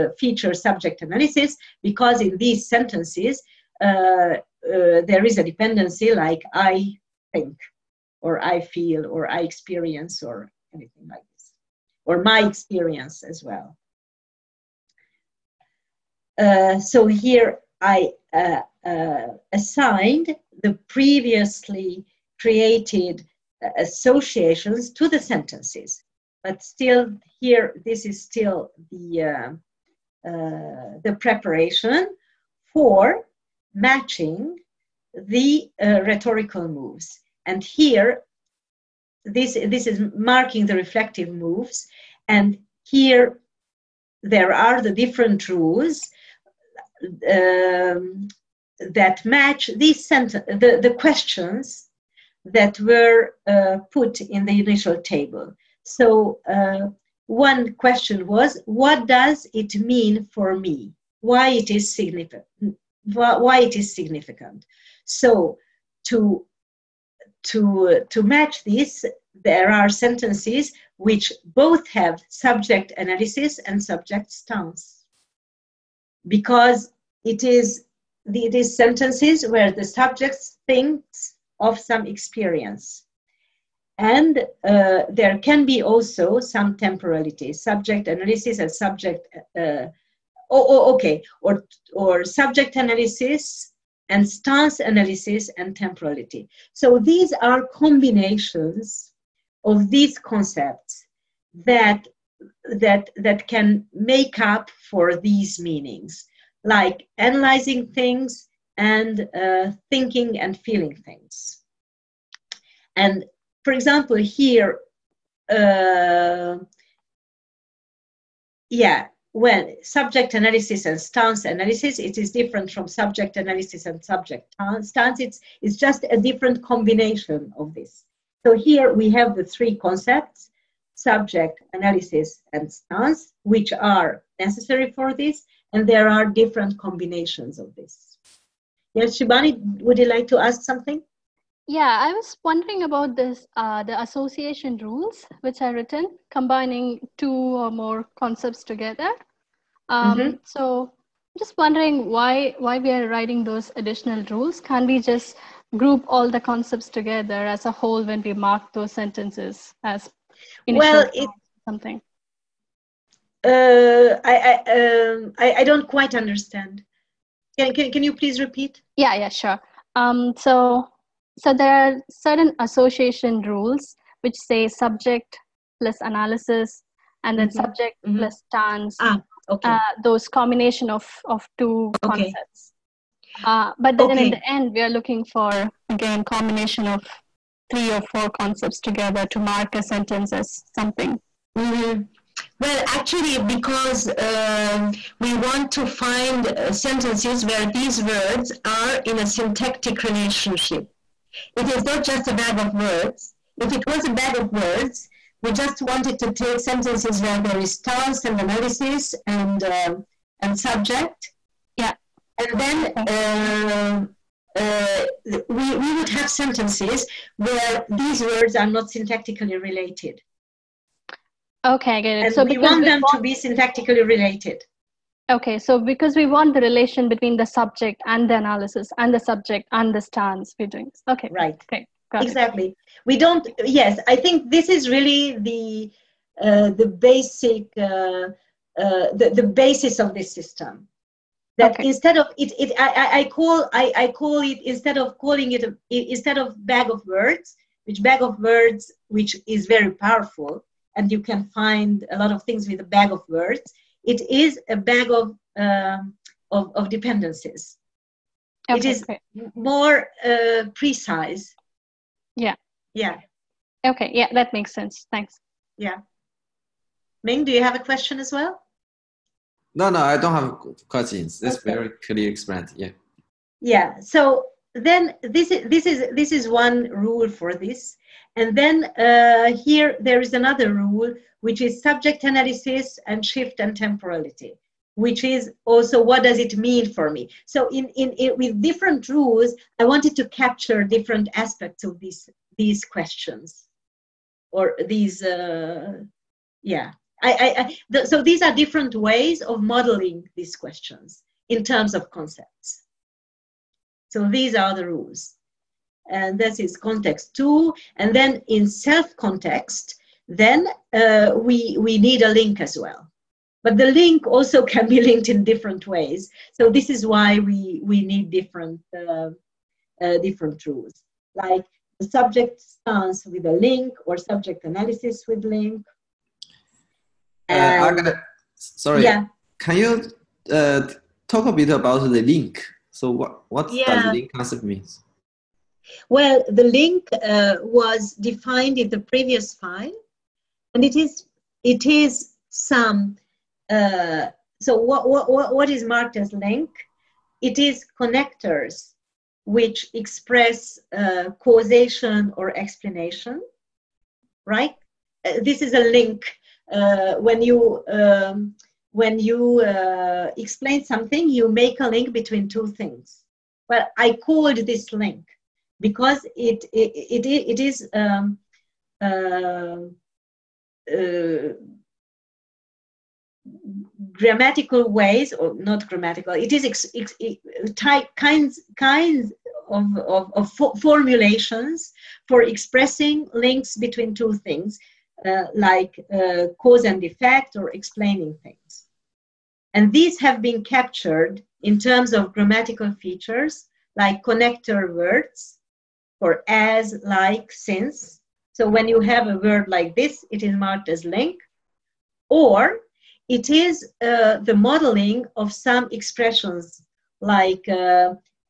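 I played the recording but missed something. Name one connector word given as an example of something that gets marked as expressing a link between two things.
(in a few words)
since.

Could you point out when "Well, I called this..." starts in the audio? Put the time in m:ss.
6:03.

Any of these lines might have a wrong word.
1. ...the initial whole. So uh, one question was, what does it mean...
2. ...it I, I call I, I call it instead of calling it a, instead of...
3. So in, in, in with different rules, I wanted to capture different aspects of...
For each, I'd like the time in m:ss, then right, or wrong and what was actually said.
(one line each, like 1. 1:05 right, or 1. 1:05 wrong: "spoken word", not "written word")
1. 0:54 wrong: "table", not "whole"
2. 4:02 right
3. 4:47 right.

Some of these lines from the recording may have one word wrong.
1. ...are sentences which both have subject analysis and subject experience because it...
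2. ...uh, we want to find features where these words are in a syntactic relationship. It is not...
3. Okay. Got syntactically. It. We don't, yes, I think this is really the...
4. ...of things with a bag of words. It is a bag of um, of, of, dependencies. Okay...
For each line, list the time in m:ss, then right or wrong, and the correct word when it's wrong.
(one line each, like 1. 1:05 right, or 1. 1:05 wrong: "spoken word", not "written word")
1. 1:09 wrong: "stance", not "experience"
2. 3:14 wrong: "sentences", not "features"
3. 3:51 wrong: "exactly", not "syntactically"
4. 4:12 right.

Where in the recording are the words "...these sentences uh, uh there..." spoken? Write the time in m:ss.
0:02.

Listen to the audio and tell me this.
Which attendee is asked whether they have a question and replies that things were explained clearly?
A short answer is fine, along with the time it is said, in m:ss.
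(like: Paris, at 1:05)
Ming, at 4:27.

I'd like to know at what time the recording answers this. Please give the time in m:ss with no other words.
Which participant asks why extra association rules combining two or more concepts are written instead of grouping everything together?
2:19.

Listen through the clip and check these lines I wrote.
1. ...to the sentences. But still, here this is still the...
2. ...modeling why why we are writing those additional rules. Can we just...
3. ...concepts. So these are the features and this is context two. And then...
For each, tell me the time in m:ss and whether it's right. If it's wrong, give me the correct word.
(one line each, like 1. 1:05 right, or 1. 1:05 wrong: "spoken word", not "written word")
1. 0:24 right
2. 2:31 wrong: "wondering", not "modeling"
3. 5:02 wrong: "rules", not "features".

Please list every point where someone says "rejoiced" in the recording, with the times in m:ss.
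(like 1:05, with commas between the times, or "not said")
not said.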